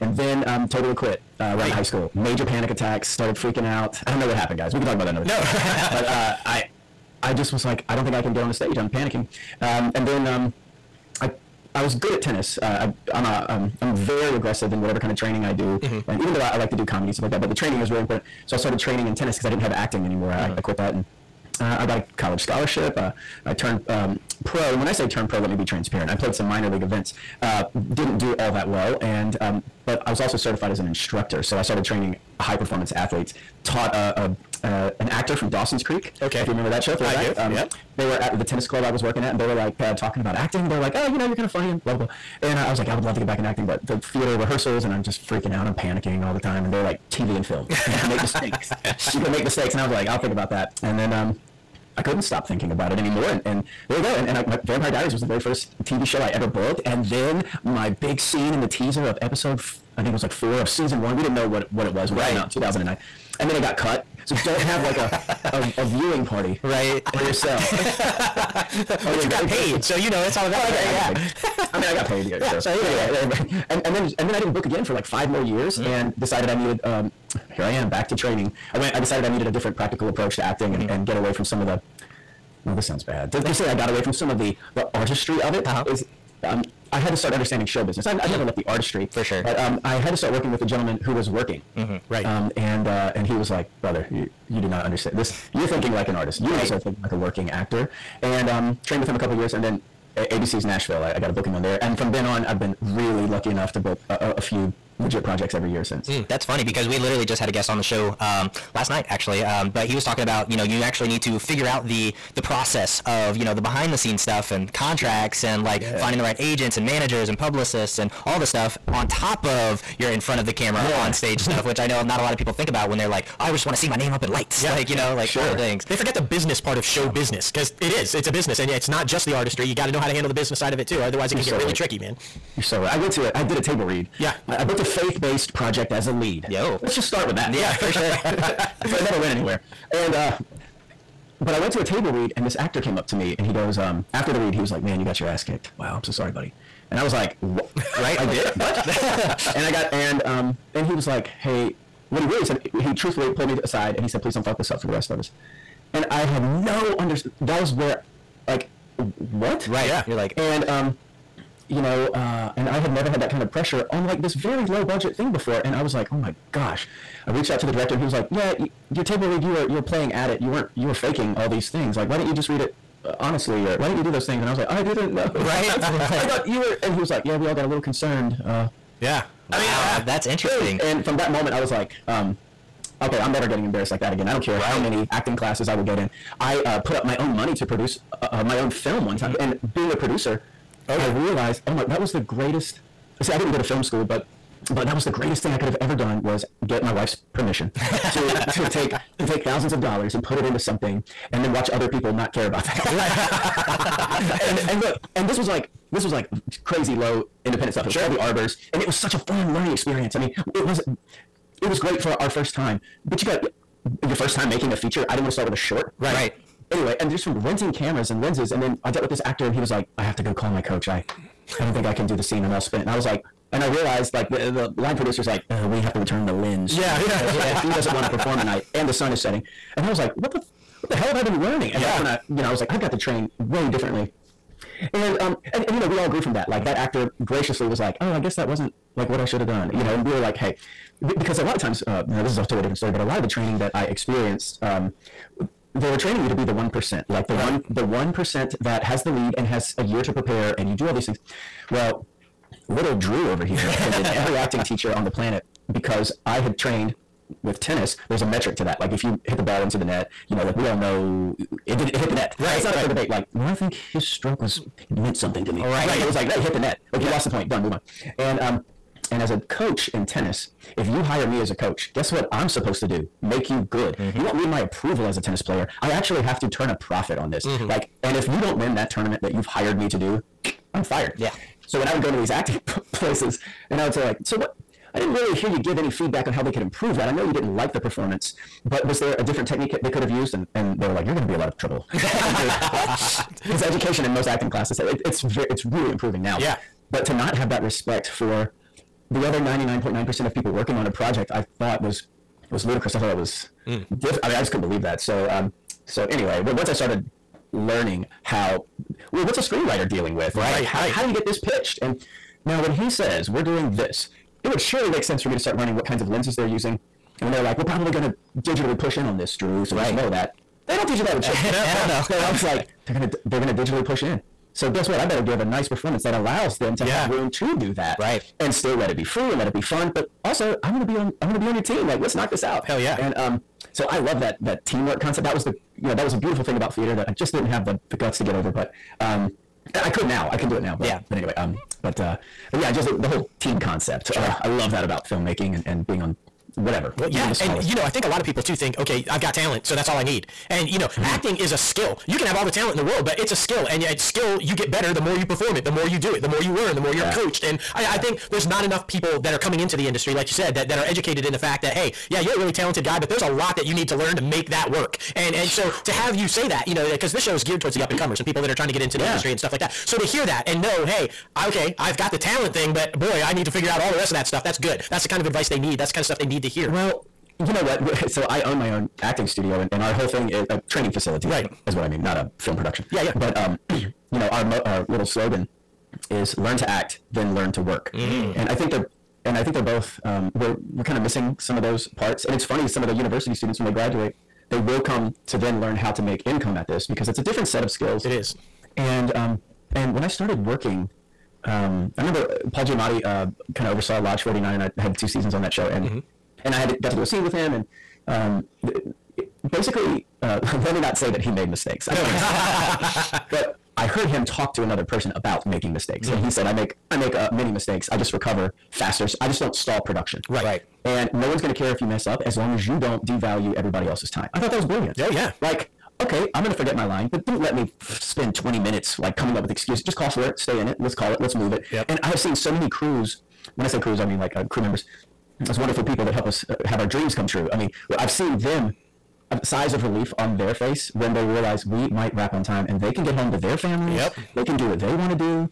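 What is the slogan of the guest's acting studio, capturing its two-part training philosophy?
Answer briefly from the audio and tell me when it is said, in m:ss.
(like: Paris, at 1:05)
Learn to act, then learn to work, at 6:26.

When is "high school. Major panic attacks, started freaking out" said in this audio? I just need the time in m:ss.
0:01.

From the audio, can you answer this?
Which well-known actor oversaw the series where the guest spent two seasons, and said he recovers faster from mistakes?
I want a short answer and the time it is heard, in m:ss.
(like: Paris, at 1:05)
Paul Giamatti, at 6:42.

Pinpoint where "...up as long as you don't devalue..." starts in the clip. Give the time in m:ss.
7:02.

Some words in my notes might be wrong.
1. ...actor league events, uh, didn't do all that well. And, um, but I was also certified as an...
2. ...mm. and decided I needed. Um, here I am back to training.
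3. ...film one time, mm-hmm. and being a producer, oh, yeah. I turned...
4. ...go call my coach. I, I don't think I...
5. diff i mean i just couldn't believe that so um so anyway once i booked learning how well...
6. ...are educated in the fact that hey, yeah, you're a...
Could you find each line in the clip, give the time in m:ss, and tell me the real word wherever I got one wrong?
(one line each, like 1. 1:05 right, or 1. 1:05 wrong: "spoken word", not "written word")
1. 0:26 wrong: "minor", not "actor"
2. 1:15 right
3. 3:08 wrong: "realized", not "turned"
4. 3:40 right
5. 5:03 wrong: "started", not "booked"
6. 6:00 right.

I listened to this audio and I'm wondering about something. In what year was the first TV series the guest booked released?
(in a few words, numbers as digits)
2009.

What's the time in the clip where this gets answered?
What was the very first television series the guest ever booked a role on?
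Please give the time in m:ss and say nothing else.
0:54.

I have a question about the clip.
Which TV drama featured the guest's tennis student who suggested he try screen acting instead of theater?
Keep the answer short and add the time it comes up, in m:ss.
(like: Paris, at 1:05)
Dawson's Creek, at 0:35.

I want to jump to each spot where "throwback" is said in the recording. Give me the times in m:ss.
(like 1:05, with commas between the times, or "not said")
0:36.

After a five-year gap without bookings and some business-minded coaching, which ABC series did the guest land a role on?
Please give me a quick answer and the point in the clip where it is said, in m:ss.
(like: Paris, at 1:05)
Nashville, at 1:40.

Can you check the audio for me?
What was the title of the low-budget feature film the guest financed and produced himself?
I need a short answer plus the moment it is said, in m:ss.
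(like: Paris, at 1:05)
The Arbors, at 3:28.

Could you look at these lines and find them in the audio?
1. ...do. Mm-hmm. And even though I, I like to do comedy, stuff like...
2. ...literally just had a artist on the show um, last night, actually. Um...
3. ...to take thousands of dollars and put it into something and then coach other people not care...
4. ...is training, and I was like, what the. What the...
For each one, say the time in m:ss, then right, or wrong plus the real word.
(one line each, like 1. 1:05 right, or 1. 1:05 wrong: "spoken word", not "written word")
1. 0:15 right
2. 1:46 wrong: "guest", not "artist"
3. 3:19 wrong: "watch", not "coach"
4. 3:49 wrong: "setting", not "training".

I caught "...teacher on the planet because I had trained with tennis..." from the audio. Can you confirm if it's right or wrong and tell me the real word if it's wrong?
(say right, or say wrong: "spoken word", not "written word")
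right.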